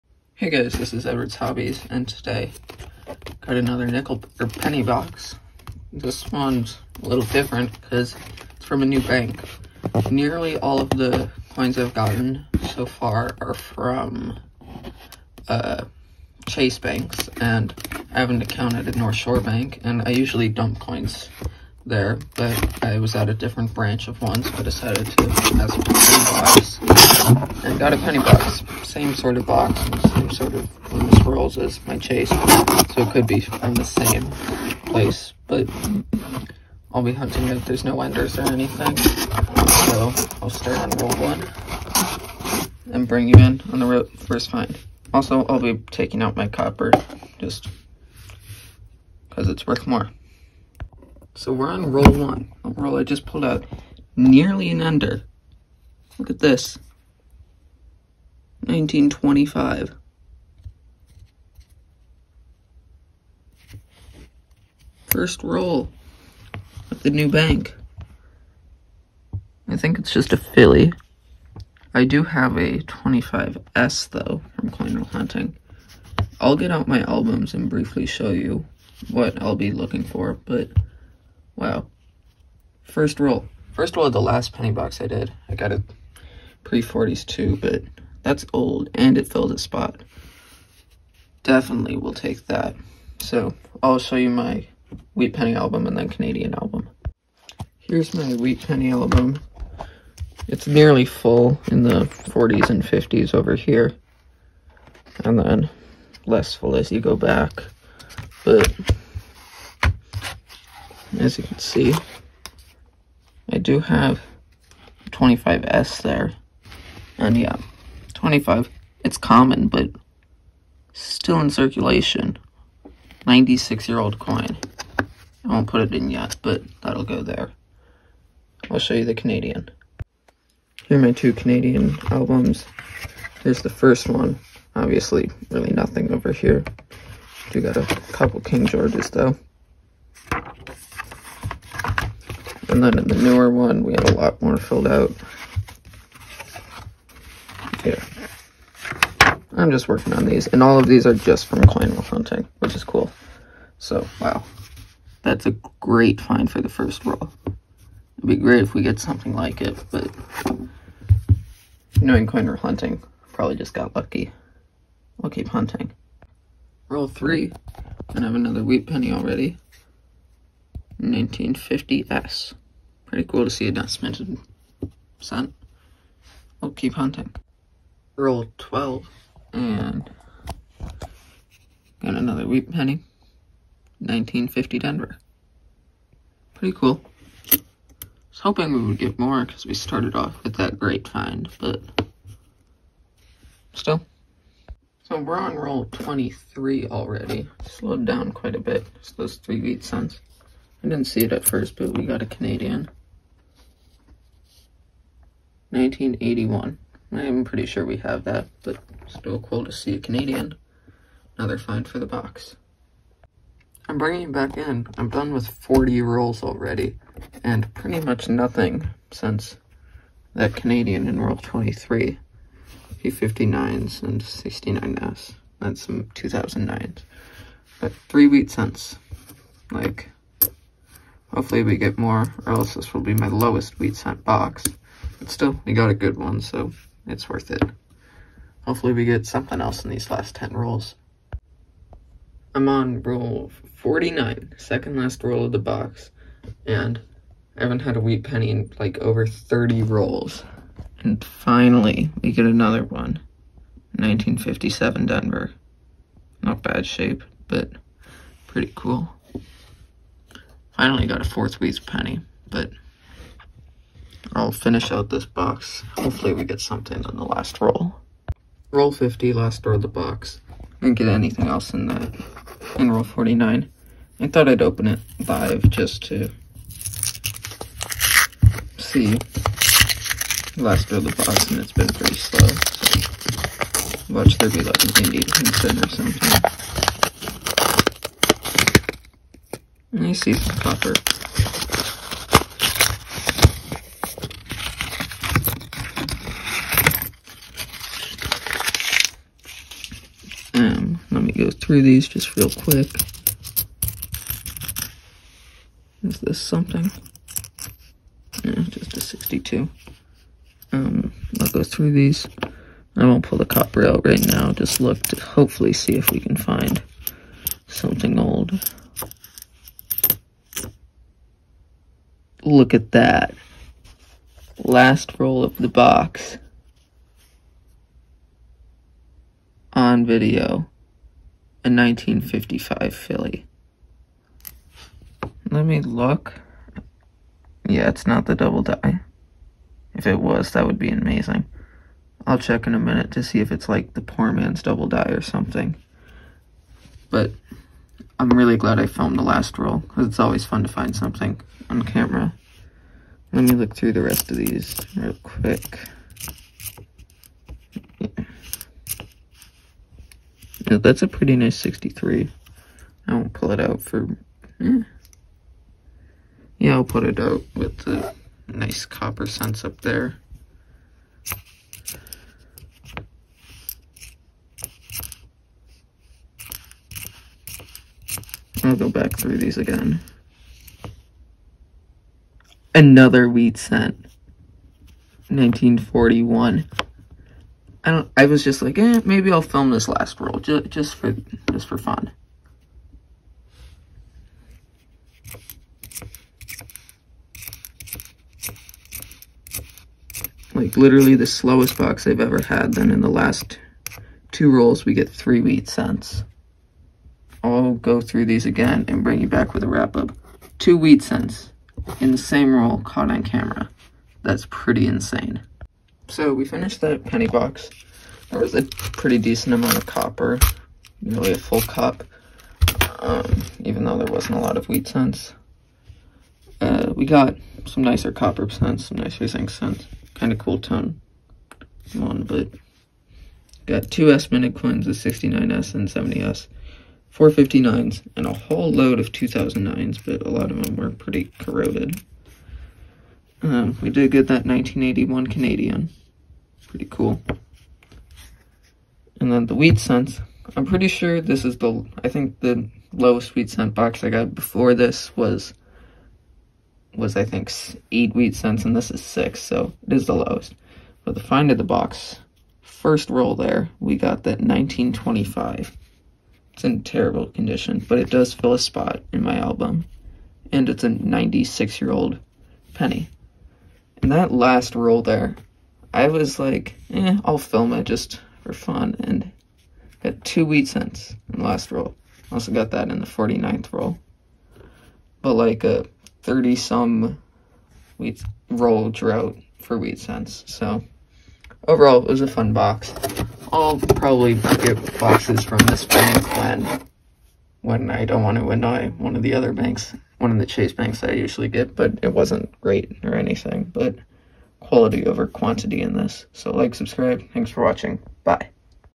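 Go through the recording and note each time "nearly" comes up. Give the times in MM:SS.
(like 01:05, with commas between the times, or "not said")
00:10, 00:54, 01:40, 07:01.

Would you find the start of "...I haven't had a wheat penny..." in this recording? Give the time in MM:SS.
04:07.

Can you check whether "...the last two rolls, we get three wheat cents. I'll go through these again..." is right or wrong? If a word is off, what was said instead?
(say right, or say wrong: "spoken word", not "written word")
right.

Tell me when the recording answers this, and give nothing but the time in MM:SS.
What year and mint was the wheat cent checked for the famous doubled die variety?
05:31.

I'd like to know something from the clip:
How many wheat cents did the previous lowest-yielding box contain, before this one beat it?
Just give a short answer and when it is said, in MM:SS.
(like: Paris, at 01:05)
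8, at 07:37.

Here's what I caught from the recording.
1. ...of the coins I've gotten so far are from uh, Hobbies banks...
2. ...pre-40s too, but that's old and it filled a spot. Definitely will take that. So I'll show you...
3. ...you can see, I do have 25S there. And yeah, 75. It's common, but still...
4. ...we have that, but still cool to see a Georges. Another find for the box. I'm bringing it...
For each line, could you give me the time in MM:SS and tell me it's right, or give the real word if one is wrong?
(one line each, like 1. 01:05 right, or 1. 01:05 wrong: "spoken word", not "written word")
1. 00:10 wrong: "Chase", not "Hobbies"
2. 01:26 right
3. 01:51 wrong: "25", not "75"
4. 03:27 wrong: "Canadian", not "Georges".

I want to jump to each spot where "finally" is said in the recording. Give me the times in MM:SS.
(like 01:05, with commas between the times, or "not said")
04:11, 04:20.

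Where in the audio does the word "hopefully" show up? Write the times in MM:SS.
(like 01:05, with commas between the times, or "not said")
03:51, 03:58, 04:25, 05:15.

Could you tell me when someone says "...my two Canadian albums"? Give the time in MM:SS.
02:11.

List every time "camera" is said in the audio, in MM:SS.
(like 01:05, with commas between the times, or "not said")
05:51, 06:53.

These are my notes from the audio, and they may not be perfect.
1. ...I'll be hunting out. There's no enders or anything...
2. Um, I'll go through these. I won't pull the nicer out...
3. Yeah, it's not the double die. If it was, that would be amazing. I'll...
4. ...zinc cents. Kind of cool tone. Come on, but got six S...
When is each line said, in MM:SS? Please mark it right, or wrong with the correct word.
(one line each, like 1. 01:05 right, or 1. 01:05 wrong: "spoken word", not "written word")
1. 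00:36 right
2. 05:10 wrong: "copper", not "nicer"
3. 05:37 right
4. 07:09 wrong: "two", not "six".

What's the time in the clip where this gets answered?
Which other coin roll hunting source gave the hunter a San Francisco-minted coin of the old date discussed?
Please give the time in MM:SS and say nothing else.
01:14.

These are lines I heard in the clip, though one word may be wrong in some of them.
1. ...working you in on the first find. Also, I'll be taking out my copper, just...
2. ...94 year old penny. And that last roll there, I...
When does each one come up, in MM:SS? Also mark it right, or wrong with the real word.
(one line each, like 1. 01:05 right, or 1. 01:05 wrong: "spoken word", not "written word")
1. 00:43 wrong: "bring", not "working"
2. 07:50 wrong: "96", not "94".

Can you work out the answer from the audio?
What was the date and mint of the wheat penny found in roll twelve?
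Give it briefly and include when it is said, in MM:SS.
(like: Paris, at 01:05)
1950 Denver, at 03:03.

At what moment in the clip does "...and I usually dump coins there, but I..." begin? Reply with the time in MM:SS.
00:19.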